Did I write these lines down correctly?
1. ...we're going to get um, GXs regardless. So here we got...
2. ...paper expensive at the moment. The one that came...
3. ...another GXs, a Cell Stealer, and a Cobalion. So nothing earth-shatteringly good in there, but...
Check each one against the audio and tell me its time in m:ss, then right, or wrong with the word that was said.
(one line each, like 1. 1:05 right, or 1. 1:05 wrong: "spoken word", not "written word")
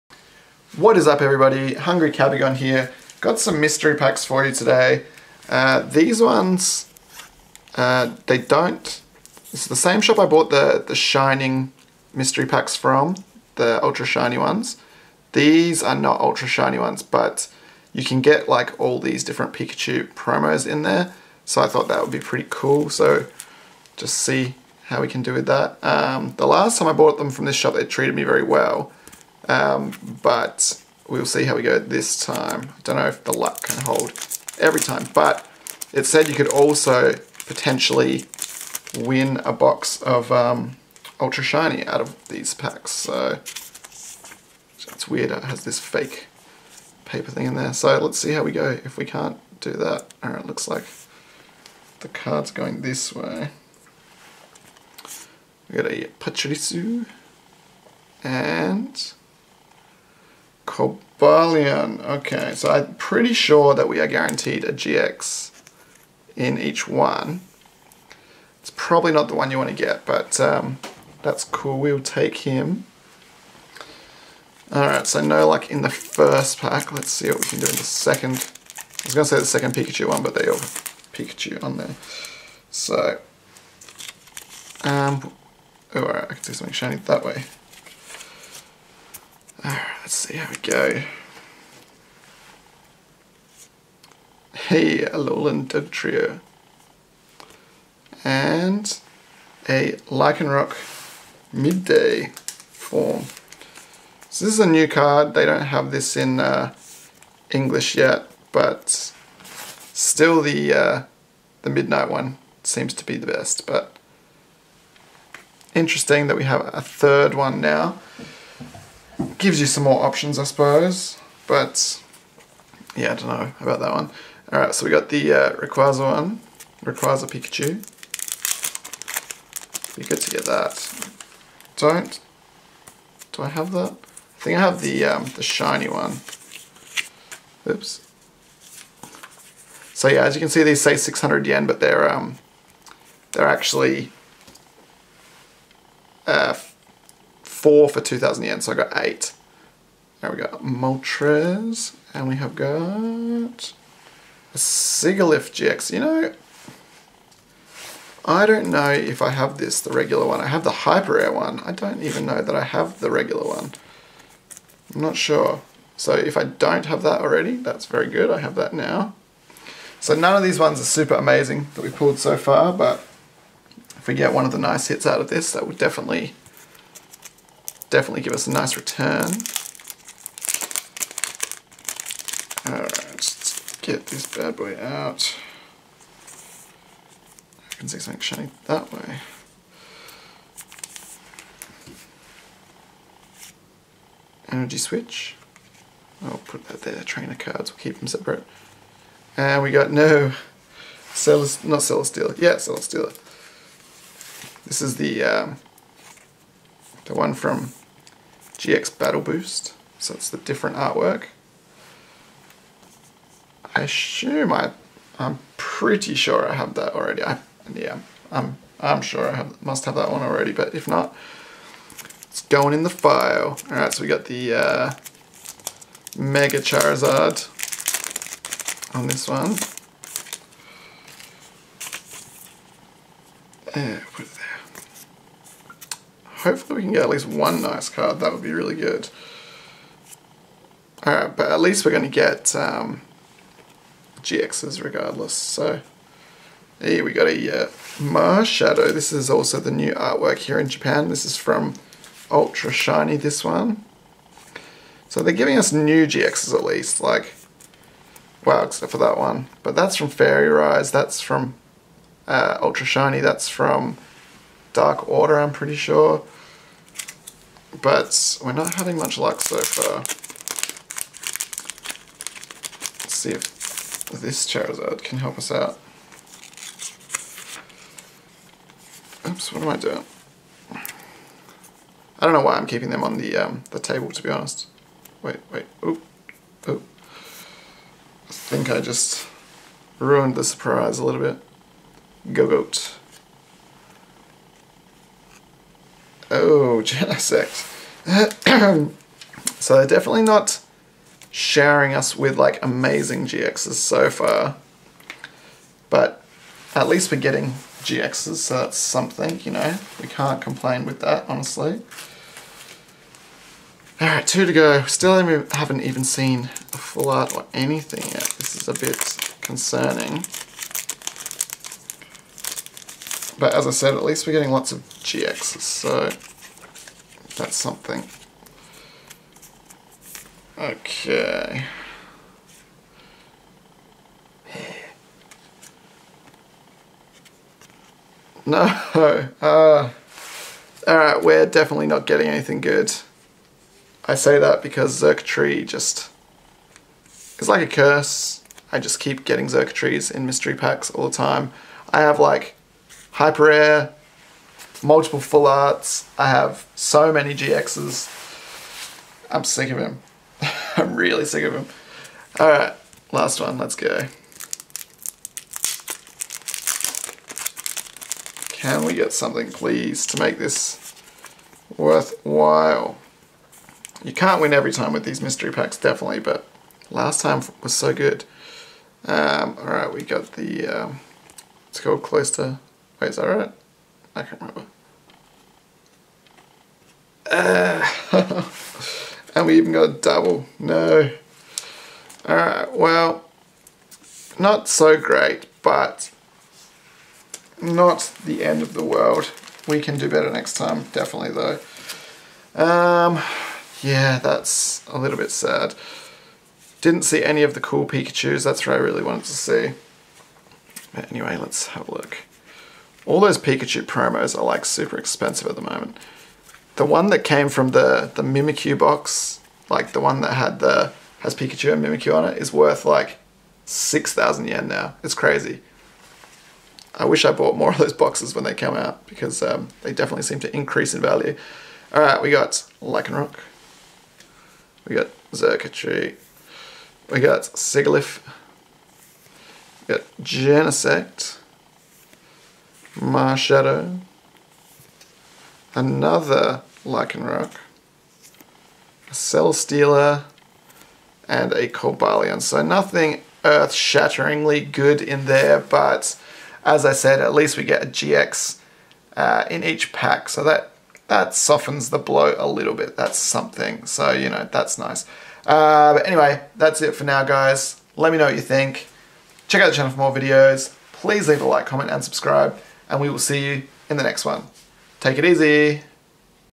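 1. 4:01 right
2. 6:54 wrong: "super", not "paper"
3. 7:25 wrong: "Lycanroc", not "GXs".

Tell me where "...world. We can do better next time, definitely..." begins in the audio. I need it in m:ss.
6:38.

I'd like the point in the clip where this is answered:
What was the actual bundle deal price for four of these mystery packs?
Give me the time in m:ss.
2:28.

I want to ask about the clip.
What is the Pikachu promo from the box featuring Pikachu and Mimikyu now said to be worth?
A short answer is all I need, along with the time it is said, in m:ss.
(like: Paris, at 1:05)
6,000 yen, at 7:03.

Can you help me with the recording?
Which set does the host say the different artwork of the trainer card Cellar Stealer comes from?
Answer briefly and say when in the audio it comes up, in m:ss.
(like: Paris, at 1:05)
GX Battle Boost, at 3:28.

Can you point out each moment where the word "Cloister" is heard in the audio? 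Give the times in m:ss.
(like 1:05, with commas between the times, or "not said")
6:22.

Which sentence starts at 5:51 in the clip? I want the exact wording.
I have like Hyper Rare, multiple full arts.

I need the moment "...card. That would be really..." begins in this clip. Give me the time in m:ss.
3:57.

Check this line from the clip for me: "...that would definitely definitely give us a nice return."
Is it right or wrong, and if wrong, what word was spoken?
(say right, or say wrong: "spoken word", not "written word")
right.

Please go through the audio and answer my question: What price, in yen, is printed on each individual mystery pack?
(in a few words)
600 yen.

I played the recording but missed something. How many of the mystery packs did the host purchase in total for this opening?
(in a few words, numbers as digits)
8.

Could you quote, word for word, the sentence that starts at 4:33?
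Let's see if this Charizard can help us out.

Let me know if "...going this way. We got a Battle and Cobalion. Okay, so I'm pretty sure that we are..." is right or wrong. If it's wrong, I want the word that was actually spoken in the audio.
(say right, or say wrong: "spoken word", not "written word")
wrong: "Pachirisu", not "Battle".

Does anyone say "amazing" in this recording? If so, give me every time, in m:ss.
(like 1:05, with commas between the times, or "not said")
2:51, 5:02.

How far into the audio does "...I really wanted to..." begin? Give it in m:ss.
6:48.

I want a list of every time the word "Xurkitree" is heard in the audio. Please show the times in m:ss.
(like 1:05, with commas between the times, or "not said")
5:45, 5:49, 7:15.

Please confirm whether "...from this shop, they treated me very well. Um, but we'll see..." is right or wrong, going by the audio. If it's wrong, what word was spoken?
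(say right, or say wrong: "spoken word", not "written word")
right.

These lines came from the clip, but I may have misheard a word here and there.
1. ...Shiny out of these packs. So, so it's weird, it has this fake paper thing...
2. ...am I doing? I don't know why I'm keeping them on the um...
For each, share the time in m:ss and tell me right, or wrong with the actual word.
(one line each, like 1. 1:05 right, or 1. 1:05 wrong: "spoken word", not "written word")
1. 0:41 right
2. 4:39 right.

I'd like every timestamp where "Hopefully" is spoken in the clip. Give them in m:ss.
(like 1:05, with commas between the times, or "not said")
3:56.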